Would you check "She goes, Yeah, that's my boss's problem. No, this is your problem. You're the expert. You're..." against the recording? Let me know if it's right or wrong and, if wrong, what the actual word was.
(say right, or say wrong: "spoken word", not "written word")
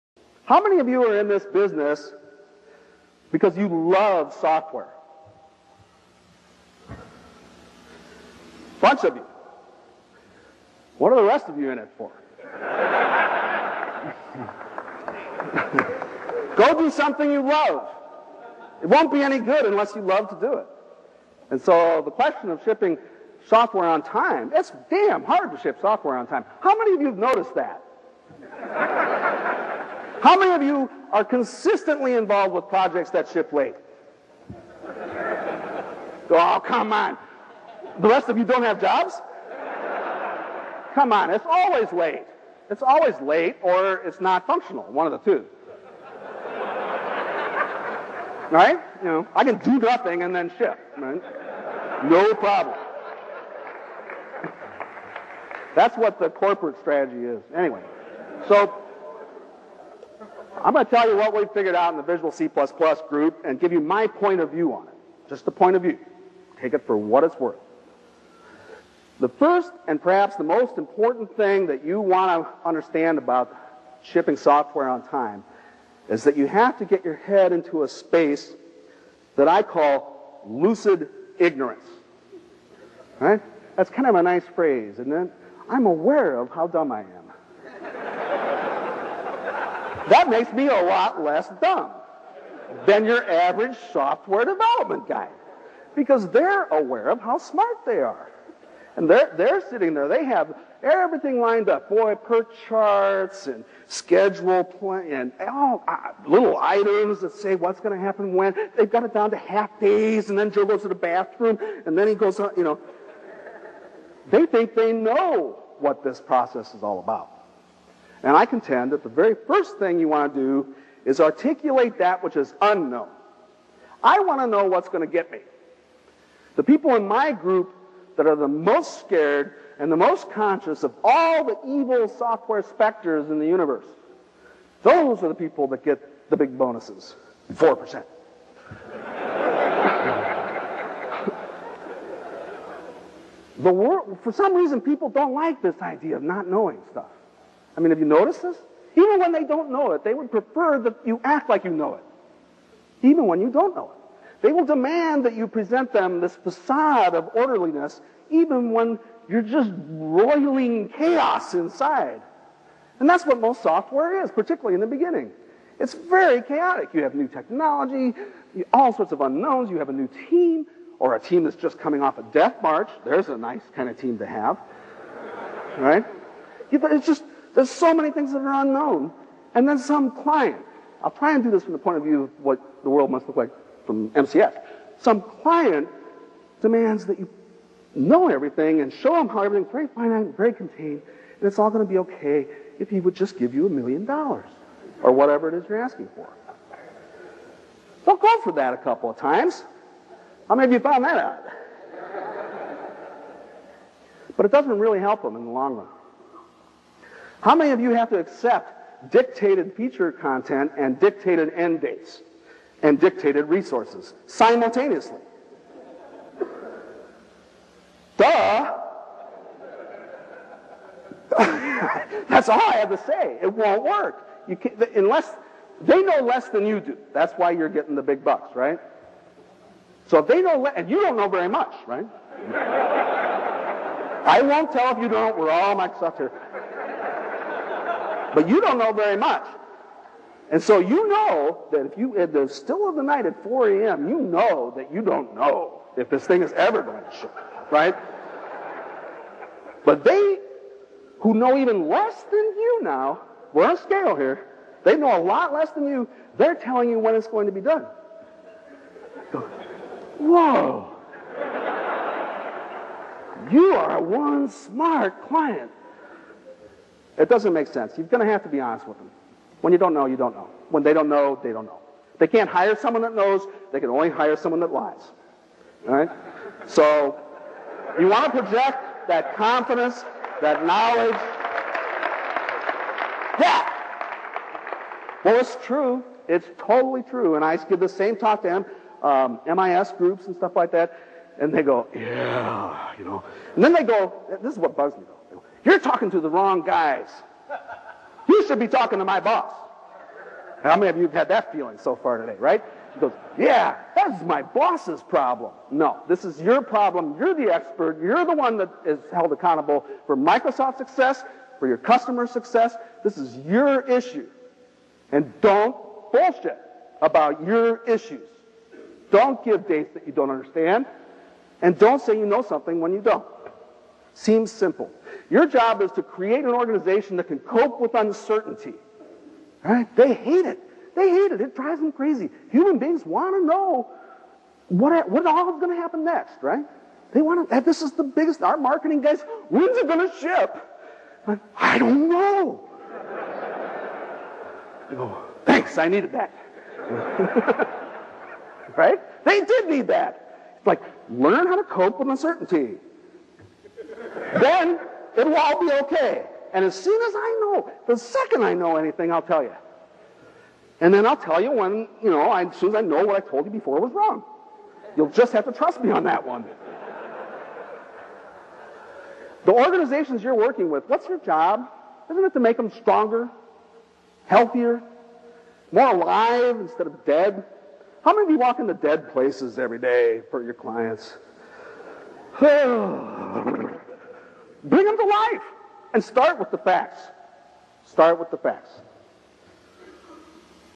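right.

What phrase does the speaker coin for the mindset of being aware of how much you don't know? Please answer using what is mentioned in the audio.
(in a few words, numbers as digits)
lucid ignorance.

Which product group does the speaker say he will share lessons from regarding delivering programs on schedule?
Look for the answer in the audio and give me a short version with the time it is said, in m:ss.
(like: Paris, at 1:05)
Visual C++ group, at 1:02.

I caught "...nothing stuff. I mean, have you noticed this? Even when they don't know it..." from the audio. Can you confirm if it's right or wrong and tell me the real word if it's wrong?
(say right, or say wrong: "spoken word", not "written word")
wrong: "knowing", not "nothing".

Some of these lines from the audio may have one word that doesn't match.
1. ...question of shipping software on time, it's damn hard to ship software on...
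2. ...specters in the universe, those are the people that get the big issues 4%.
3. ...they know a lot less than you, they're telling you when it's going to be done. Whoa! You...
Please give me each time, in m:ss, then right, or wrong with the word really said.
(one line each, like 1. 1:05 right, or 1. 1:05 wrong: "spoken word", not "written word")
1. 0:22 right
2. 2:12 wrong: "bonuses", not "issues"
3. 4:14 right.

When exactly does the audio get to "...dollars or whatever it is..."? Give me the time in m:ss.
3:14.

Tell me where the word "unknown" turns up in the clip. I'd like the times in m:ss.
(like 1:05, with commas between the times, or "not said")
2:02, 2:49, 2:58.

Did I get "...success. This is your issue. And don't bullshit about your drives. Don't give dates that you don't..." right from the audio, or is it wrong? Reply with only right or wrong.
wrong.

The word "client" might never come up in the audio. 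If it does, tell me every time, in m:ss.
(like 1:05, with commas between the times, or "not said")
3:00, 3:05, 4:25, 6:20.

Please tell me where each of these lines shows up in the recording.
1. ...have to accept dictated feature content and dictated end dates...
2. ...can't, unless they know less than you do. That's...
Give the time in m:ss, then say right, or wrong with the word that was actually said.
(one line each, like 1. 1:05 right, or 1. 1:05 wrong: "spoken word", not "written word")
1. 3:27 right
2. 3:44 right.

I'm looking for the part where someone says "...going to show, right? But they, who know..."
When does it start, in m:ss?
4:06.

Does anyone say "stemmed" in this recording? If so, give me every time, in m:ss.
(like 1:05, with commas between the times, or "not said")
not said.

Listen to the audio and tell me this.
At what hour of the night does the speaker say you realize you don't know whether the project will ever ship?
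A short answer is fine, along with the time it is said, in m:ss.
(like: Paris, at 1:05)
4 a.m., at 4:03.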